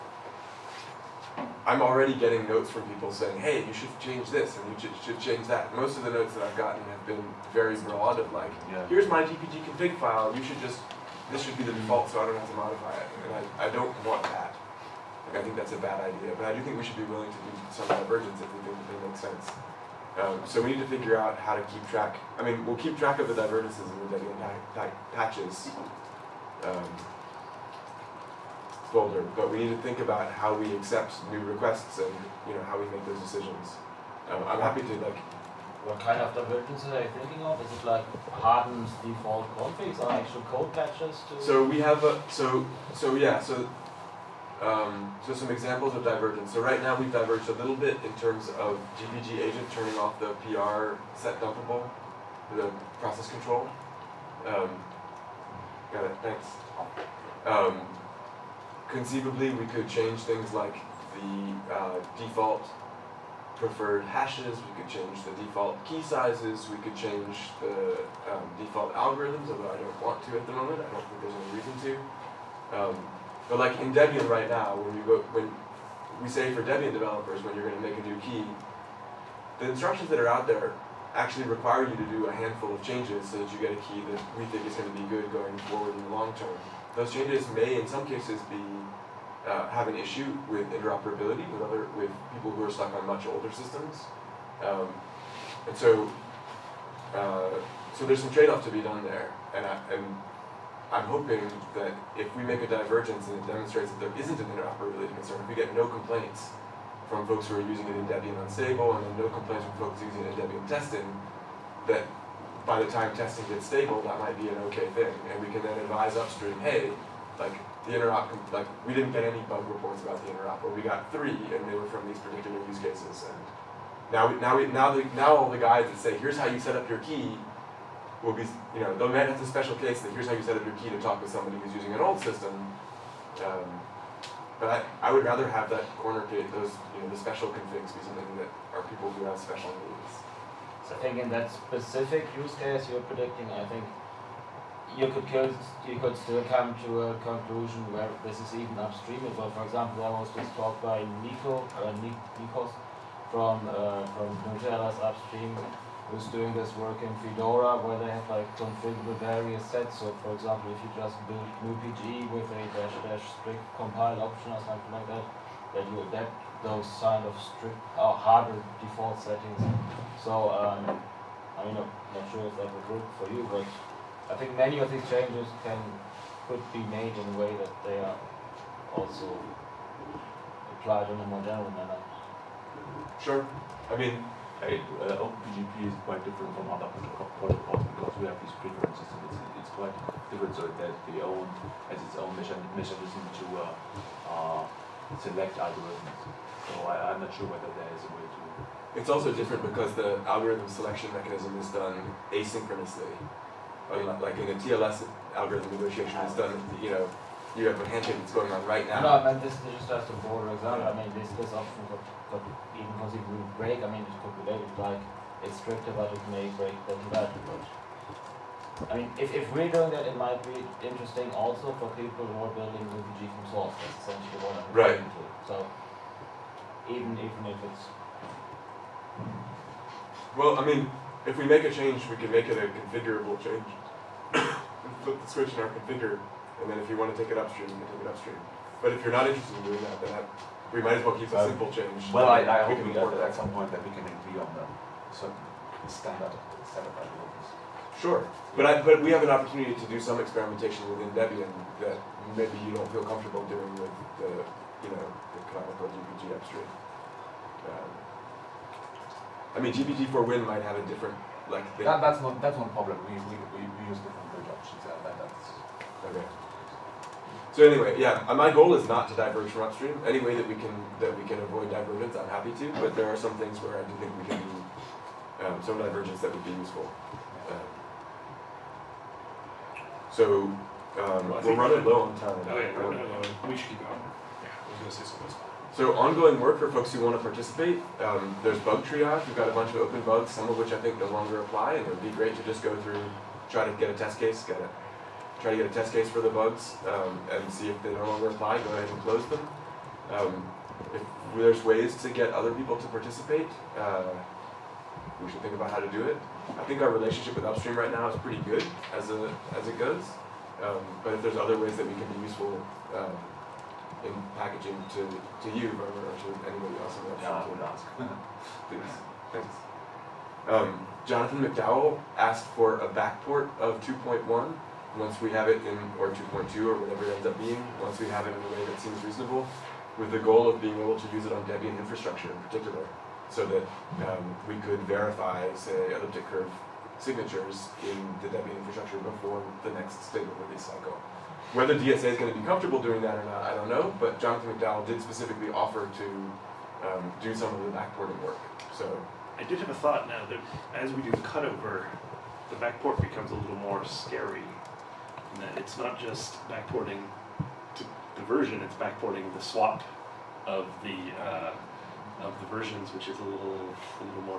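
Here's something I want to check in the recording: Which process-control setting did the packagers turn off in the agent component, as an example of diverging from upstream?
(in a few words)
PR set dumpable.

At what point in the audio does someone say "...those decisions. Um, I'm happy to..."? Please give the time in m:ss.
0:33.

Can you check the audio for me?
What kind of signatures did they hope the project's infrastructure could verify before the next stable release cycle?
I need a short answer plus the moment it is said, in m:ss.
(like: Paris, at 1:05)
elliptic curve, at 5:35.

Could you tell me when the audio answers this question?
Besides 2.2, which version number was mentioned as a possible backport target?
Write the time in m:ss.
5:23.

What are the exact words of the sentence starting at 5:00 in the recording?
Um, if there's ways to get other people to participate, uh, we should think about how to do it.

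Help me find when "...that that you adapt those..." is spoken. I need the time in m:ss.
2:45.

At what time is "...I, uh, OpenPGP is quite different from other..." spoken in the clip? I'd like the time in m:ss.
3:04.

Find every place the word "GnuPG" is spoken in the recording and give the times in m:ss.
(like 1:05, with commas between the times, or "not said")
2:41.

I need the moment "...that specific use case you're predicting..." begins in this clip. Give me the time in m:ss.
2:21.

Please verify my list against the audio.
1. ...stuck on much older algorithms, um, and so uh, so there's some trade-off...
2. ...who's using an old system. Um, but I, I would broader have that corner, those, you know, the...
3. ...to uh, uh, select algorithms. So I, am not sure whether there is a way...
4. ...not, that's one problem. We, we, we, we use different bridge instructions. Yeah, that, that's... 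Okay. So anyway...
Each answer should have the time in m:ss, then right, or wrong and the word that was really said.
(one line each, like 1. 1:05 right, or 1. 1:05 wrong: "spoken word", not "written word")
1. 1:32 wrong: "systems", not "algorithms"
2. 2:11 wrong: "rather", not "broader"
3. 3:13 right
4. 4:22 wrong: "options", not "instructions".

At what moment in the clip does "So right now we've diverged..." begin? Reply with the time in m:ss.
0:46.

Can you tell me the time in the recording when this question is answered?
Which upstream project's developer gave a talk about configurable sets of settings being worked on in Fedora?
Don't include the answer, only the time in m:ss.
2:34.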